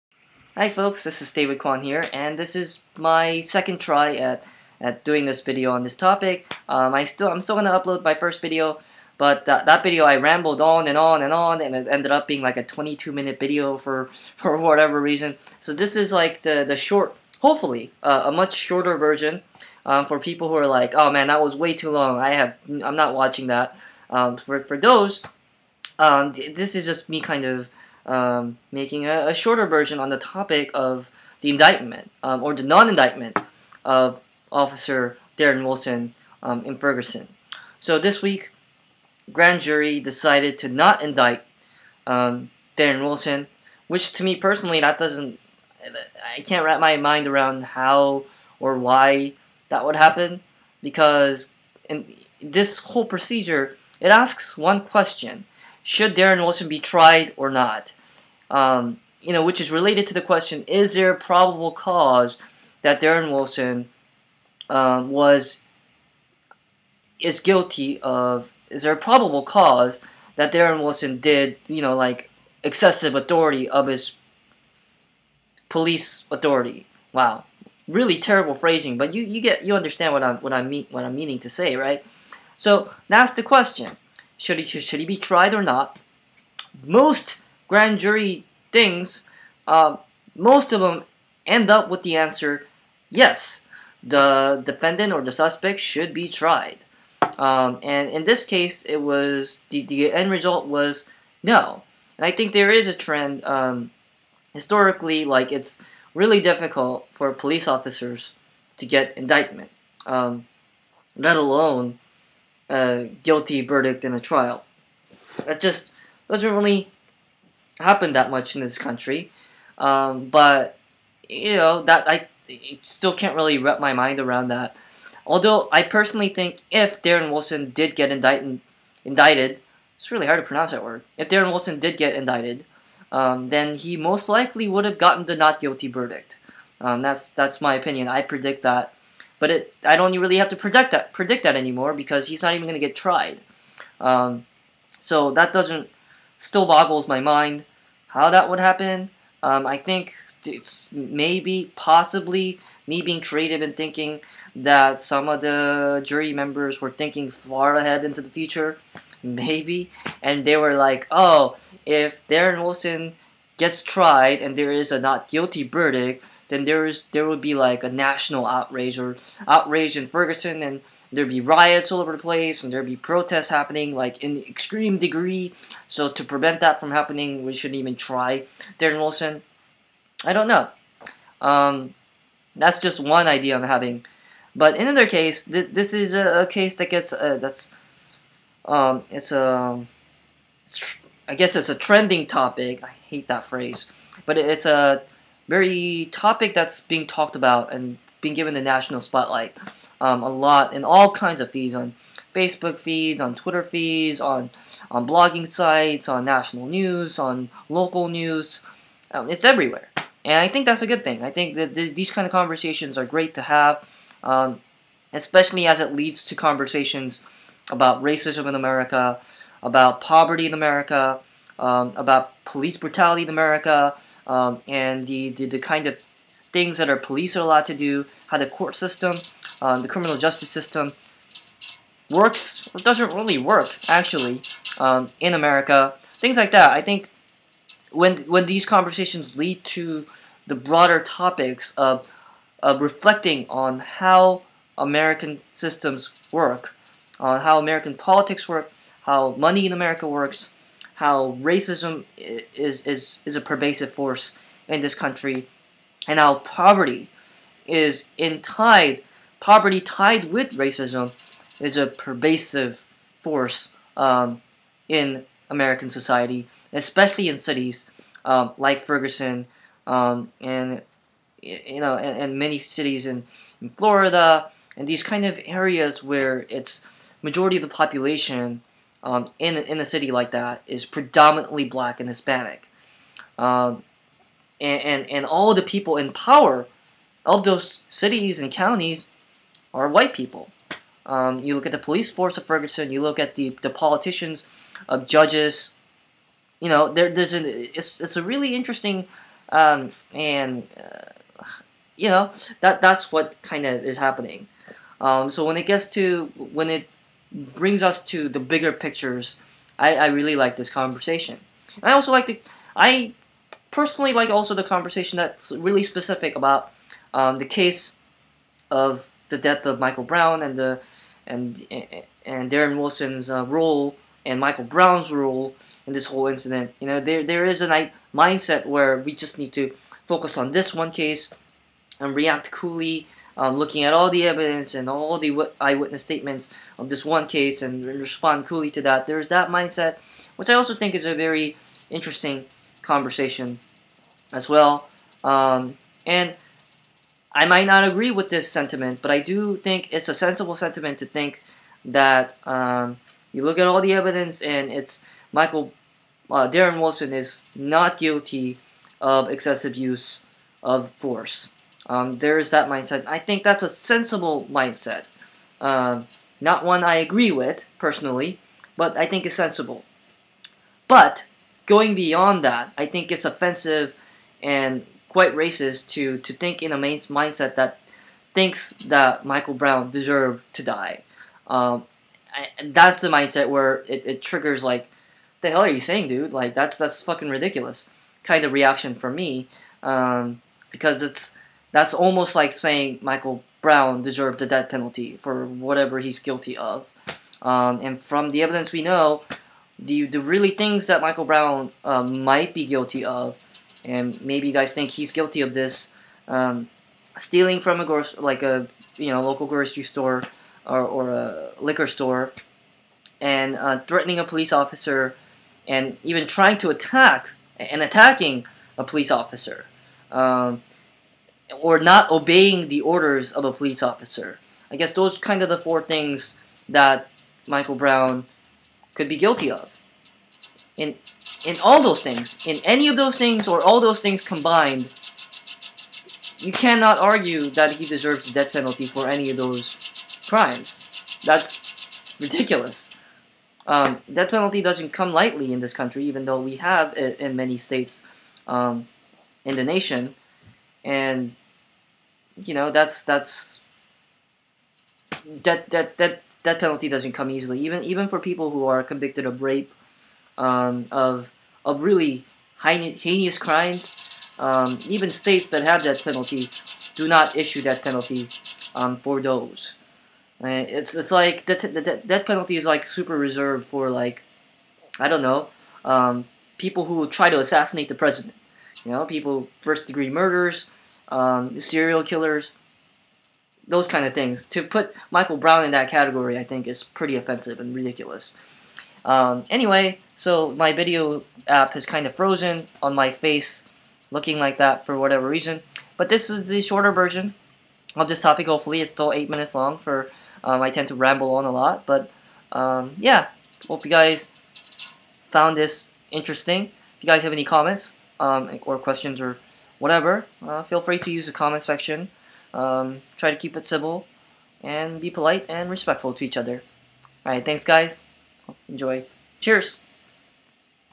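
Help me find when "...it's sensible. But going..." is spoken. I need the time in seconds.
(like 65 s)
369 s.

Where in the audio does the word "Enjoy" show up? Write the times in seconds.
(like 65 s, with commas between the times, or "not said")
518 s.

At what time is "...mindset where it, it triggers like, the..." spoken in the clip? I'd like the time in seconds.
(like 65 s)
383 s.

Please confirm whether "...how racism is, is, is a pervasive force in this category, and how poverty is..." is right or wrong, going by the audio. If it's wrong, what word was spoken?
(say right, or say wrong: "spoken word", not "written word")
wrong: "country", not "category".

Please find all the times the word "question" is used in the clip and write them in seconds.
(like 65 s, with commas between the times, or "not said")
54 s, 60 s, 83 s, 508 s.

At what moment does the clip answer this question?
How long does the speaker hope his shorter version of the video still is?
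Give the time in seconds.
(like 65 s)
499 s.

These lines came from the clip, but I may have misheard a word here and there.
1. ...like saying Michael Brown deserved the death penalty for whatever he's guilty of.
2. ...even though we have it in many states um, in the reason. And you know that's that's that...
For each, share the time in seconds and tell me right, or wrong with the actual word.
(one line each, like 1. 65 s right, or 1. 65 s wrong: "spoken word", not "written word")
1. 392 s right
2. 446 s wrong: "nation", not "reason".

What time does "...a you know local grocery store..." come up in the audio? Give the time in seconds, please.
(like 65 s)
408 s.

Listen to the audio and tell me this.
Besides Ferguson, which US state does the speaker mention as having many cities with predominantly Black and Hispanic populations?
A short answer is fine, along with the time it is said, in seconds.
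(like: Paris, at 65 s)
Florida, at 273 s.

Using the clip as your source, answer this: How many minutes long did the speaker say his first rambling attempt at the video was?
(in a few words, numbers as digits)
22 minutes.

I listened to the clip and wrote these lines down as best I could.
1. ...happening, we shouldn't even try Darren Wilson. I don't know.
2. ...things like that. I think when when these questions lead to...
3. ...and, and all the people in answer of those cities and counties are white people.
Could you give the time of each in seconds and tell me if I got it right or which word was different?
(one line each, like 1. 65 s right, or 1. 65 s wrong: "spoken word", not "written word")
1. 176 s right
2. 236 s wrong: "conversations", not "questions"
3. 284 s wrong: "power", not "answer".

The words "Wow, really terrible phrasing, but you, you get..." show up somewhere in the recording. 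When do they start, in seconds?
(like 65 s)
77 s.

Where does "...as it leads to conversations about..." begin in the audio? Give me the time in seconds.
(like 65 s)
215 s.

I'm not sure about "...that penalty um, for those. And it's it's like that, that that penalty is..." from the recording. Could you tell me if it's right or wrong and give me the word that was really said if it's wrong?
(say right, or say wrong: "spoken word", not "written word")
right.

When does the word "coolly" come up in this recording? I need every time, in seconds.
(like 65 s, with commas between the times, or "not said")
332 s, 338 s.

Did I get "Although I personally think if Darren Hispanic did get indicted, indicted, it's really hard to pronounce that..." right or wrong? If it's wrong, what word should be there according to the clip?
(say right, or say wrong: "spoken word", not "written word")
wrong: "Wilson", not "Hispanic".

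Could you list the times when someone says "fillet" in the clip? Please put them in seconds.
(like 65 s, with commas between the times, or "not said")
not said.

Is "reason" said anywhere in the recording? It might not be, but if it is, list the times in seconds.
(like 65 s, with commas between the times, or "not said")
14 s, 495 s.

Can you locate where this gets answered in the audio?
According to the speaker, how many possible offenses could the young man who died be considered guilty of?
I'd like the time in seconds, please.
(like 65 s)
425 s.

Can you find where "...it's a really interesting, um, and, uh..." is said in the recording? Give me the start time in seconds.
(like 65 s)
298 s.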